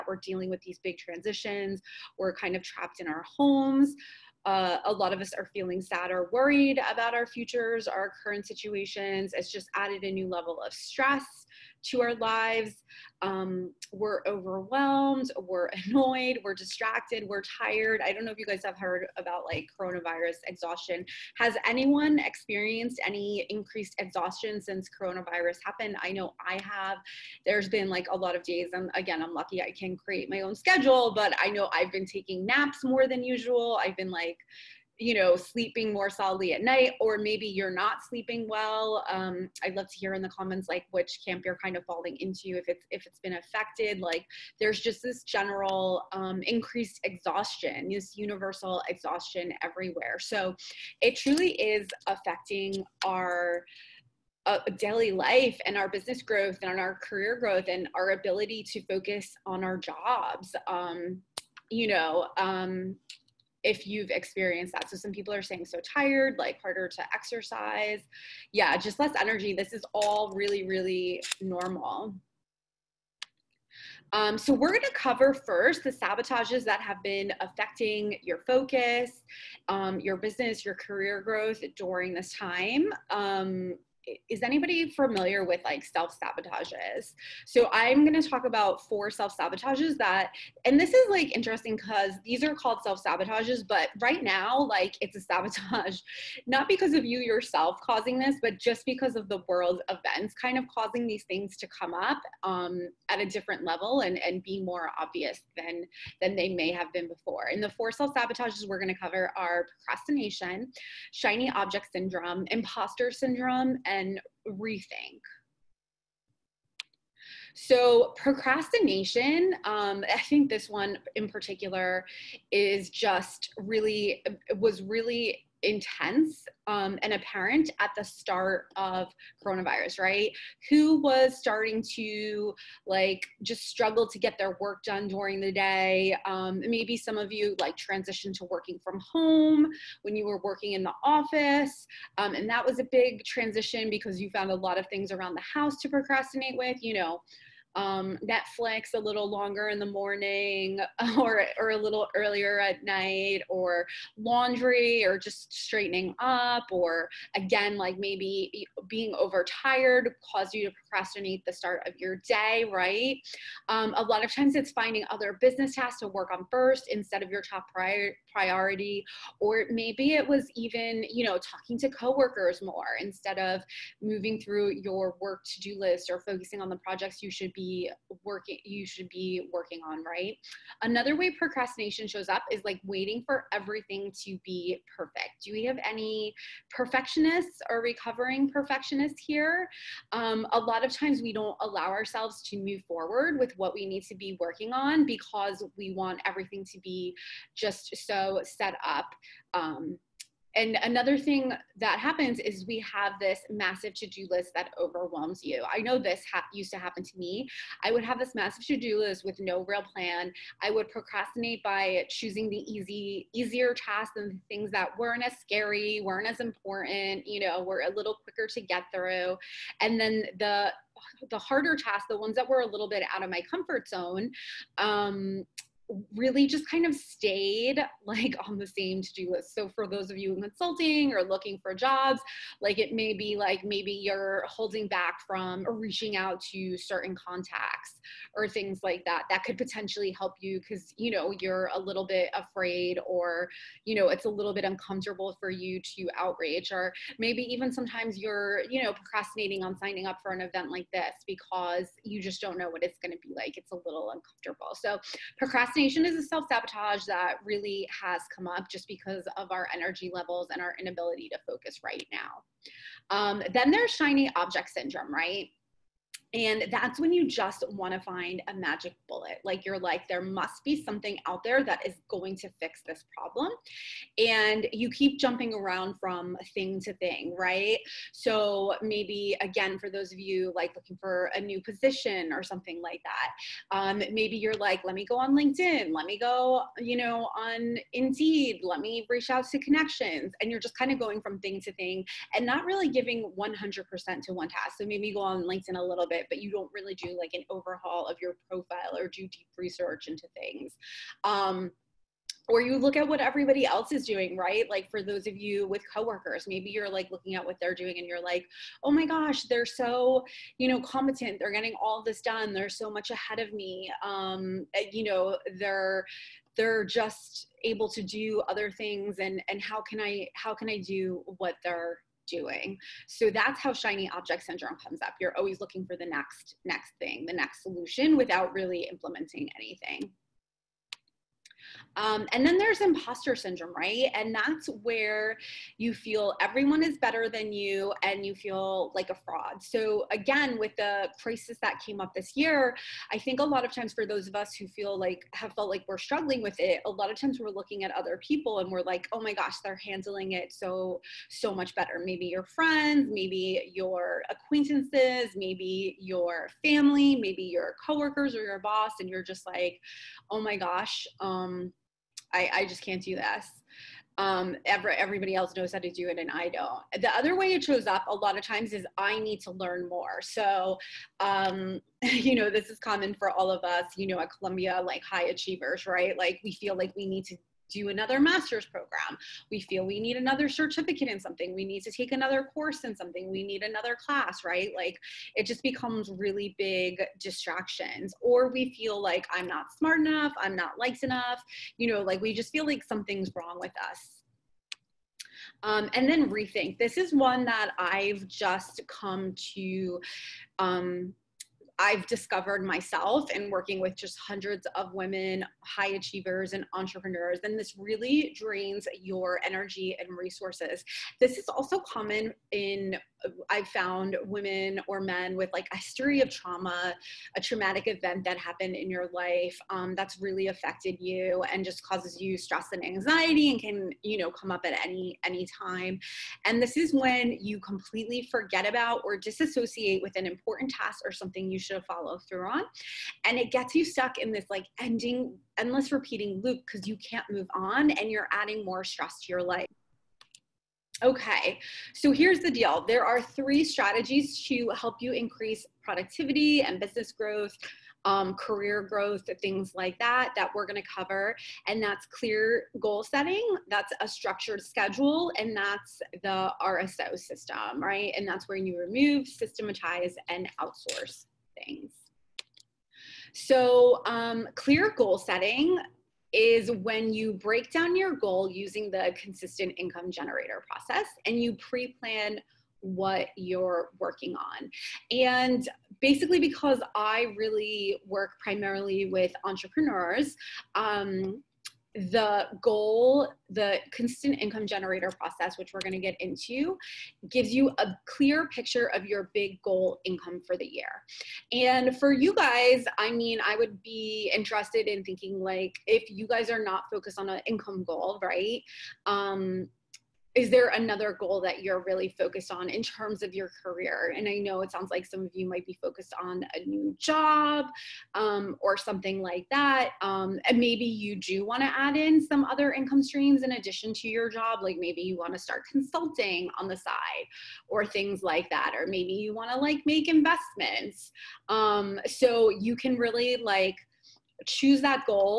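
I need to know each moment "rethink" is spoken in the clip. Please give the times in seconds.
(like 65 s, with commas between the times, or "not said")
114 s, 396 s.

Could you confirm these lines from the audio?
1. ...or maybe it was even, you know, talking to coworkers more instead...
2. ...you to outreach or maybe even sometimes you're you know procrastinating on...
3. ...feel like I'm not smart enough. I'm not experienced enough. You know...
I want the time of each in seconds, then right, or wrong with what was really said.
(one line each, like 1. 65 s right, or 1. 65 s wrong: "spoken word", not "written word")
1. 169 s right
2. 245 s right
3. 388 s wrong: "liked", not "experienced".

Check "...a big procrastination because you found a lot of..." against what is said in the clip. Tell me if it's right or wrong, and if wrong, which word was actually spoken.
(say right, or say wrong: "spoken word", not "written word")
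wrong: "transition", not "procrastination".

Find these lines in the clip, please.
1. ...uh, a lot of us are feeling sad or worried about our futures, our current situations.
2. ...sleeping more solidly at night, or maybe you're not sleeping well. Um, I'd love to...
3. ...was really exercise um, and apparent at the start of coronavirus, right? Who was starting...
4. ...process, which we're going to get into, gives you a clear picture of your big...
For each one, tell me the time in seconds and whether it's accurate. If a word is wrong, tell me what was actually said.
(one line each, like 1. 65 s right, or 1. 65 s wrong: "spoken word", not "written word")
1. 4 s right
2. 35 s right
3. 124 s wrong: "intense", not "exercise"
4. 485 s right.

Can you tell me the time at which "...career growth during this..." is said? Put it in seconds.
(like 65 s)
80 s.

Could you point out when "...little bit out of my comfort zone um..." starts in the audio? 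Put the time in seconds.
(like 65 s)
222 s.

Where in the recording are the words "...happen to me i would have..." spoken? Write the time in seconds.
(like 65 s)
206 s.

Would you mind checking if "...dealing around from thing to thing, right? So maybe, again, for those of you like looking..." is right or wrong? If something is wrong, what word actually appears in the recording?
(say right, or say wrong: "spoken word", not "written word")
wrong: "jumping", not "dealing".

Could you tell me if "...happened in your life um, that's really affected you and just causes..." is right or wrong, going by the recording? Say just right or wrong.
right.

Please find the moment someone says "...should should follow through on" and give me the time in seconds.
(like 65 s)
431 s.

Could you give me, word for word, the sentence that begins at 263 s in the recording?
Um, then there's shiny object syndrome, right?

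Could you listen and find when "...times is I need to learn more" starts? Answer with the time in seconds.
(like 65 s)
368 s.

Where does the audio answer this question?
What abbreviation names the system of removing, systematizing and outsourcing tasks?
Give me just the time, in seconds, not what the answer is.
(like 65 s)
456 s.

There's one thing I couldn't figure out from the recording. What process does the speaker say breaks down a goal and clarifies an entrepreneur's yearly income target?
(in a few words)
consistent income generator process.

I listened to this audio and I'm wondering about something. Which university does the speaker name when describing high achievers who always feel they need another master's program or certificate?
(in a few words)
Columbia.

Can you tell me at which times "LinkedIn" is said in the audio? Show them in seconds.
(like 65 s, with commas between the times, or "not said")
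285 s, 295 s.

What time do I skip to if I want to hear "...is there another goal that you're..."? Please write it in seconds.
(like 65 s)
500 s.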